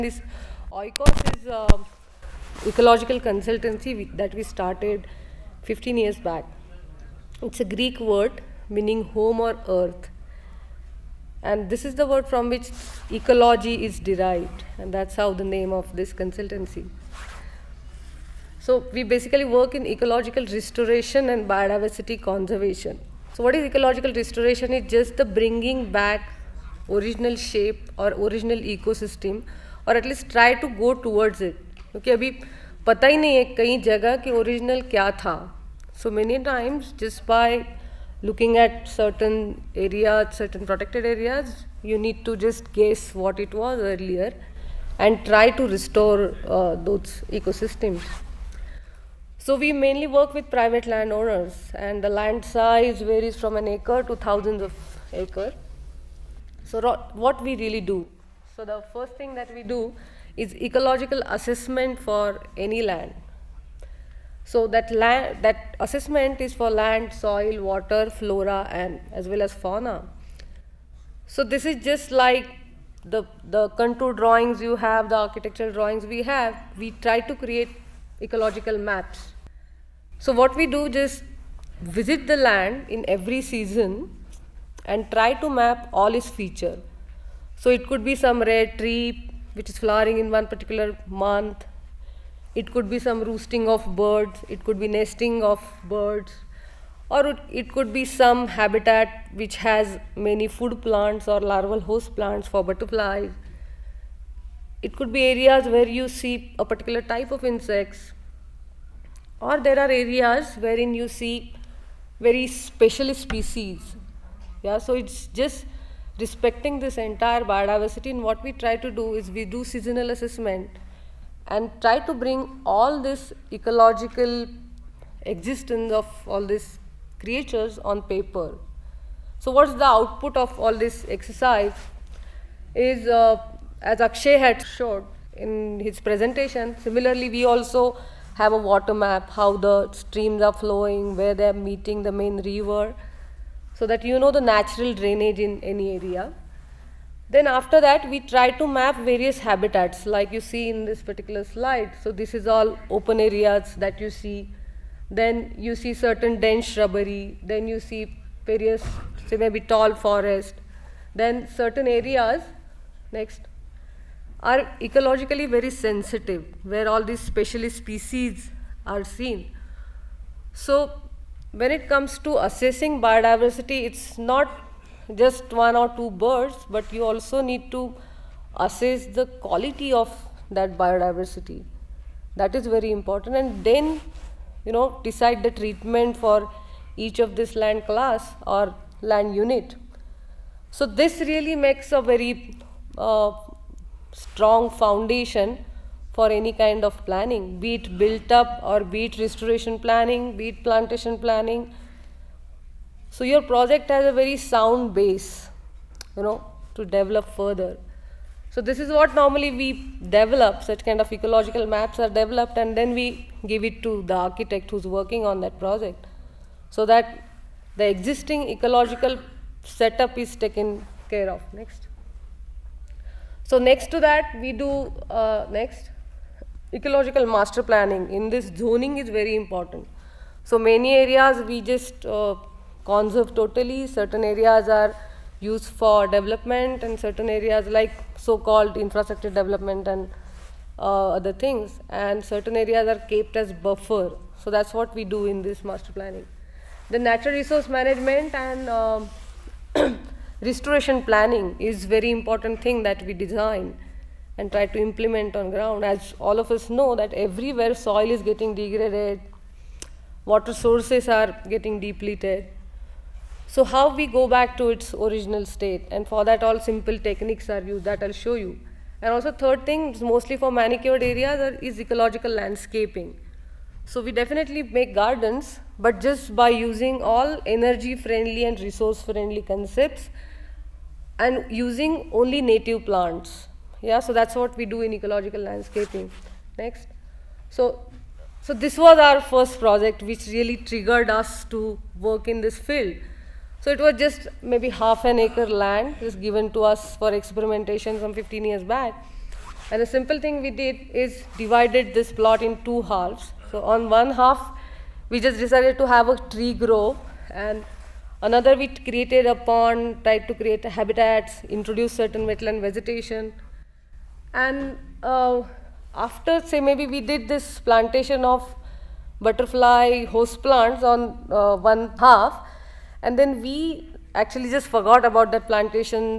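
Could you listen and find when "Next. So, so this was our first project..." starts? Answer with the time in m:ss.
4:46.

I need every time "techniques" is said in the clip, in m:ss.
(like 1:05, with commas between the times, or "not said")
4:26.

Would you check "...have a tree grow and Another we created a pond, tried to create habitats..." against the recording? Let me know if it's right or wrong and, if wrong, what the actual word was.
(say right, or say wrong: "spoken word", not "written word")
right.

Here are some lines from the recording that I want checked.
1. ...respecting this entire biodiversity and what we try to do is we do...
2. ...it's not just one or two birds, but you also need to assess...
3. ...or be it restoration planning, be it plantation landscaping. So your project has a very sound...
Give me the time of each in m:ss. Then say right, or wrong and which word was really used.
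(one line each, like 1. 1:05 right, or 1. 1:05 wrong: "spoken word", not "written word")
1. 1:56 right
2. 2:53 right
3. 3:18 wrong: "planning", not "landscaping".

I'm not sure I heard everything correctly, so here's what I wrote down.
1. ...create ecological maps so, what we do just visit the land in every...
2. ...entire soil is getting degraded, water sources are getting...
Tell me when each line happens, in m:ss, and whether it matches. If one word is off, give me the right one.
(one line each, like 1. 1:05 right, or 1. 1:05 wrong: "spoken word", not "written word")
1. 1:17 right
2. 4:17 wrong: "everywhere", not "entire".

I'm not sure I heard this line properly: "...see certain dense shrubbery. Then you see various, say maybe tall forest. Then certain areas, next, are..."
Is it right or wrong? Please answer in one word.
right.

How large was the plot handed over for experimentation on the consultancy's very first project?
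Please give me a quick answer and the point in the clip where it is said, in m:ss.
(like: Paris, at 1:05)
half an acre, at 4:54.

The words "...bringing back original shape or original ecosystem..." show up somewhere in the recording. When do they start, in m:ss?
0:25.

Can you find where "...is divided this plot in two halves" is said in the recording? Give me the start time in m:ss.
5:00.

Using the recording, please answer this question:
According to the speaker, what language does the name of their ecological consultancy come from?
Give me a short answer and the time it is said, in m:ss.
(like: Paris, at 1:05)
Greek, at 0:07.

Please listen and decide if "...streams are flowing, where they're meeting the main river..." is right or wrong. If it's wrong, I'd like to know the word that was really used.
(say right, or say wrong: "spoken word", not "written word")
right.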